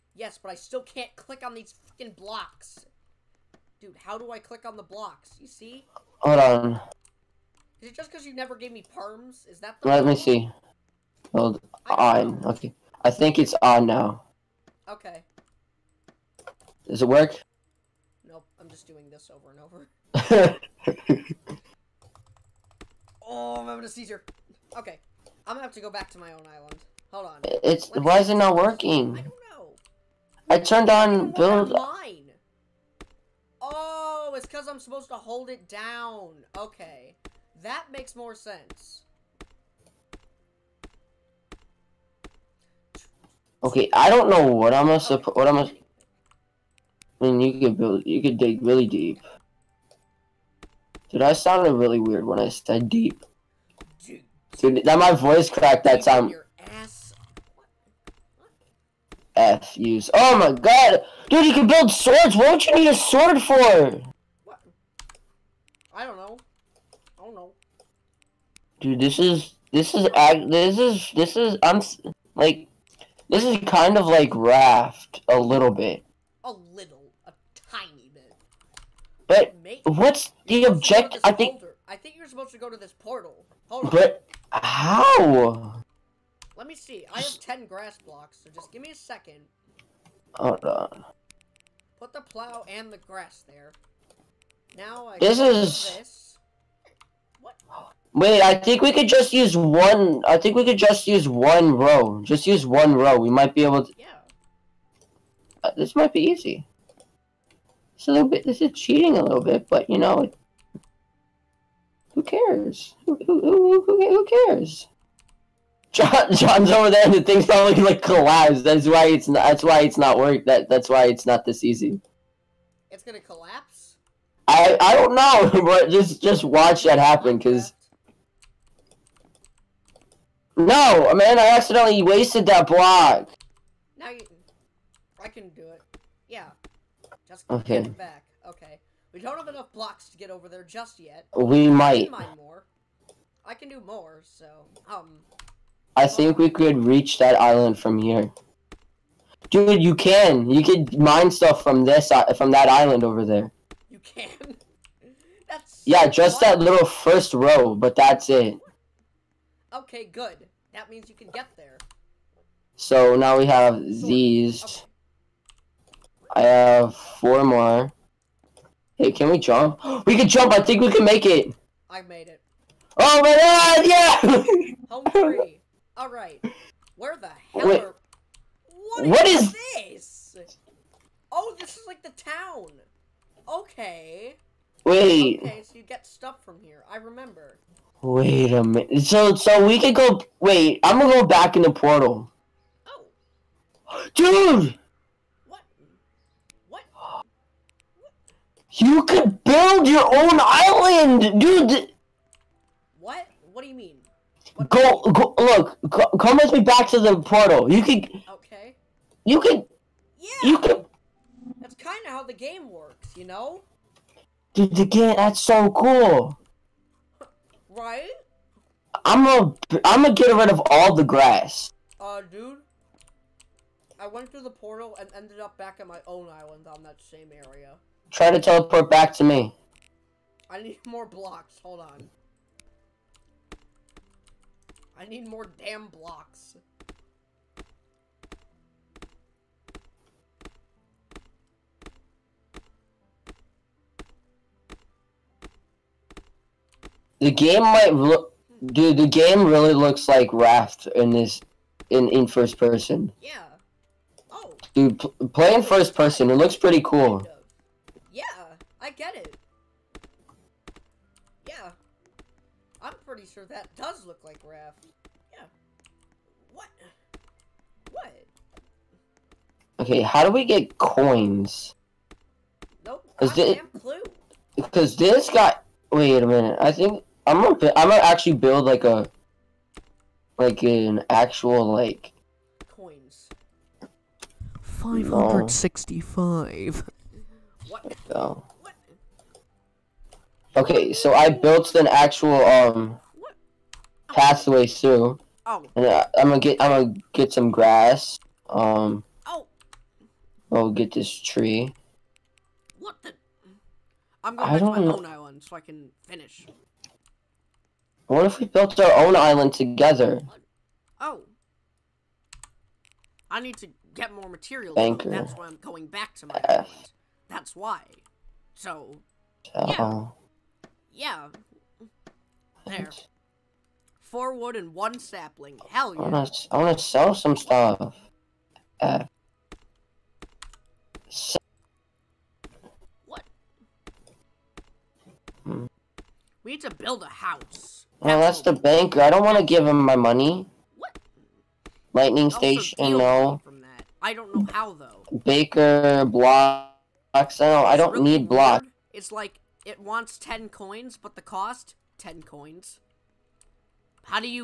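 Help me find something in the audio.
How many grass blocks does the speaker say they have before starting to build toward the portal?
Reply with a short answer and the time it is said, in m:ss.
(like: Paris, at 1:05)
10, at 1:27.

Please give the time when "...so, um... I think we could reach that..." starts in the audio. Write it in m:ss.
2:24.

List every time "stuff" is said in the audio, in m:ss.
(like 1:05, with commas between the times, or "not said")
2:31, 3:06, 5:27.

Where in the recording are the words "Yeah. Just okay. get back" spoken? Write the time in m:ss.
2:16.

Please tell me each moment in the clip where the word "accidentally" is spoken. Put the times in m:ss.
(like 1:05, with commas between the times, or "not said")
2:11.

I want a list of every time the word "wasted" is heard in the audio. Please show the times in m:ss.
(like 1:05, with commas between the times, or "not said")
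2:12.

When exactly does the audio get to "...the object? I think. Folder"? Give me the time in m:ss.
1:20.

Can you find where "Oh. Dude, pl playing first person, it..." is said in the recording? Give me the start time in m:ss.
4:14.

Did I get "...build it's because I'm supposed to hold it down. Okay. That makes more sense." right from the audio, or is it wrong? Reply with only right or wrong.
right.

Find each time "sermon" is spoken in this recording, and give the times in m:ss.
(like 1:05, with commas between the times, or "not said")
not said.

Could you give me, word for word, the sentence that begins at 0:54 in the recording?
Dude, Dude that my voice cracked that time.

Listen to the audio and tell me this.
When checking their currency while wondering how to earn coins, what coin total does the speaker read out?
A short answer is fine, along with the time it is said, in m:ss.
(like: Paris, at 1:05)
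565, at 4:44.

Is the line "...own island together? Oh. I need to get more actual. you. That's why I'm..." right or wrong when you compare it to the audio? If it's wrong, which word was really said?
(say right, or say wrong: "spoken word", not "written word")
wrong: "material", not "actual".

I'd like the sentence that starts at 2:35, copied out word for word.
yeah, just that little first row, but that's it.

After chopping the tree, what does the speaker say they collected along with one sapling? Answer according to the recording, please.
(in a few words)
4 wood.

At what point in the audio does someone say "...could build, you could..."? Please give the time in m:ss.
0:47.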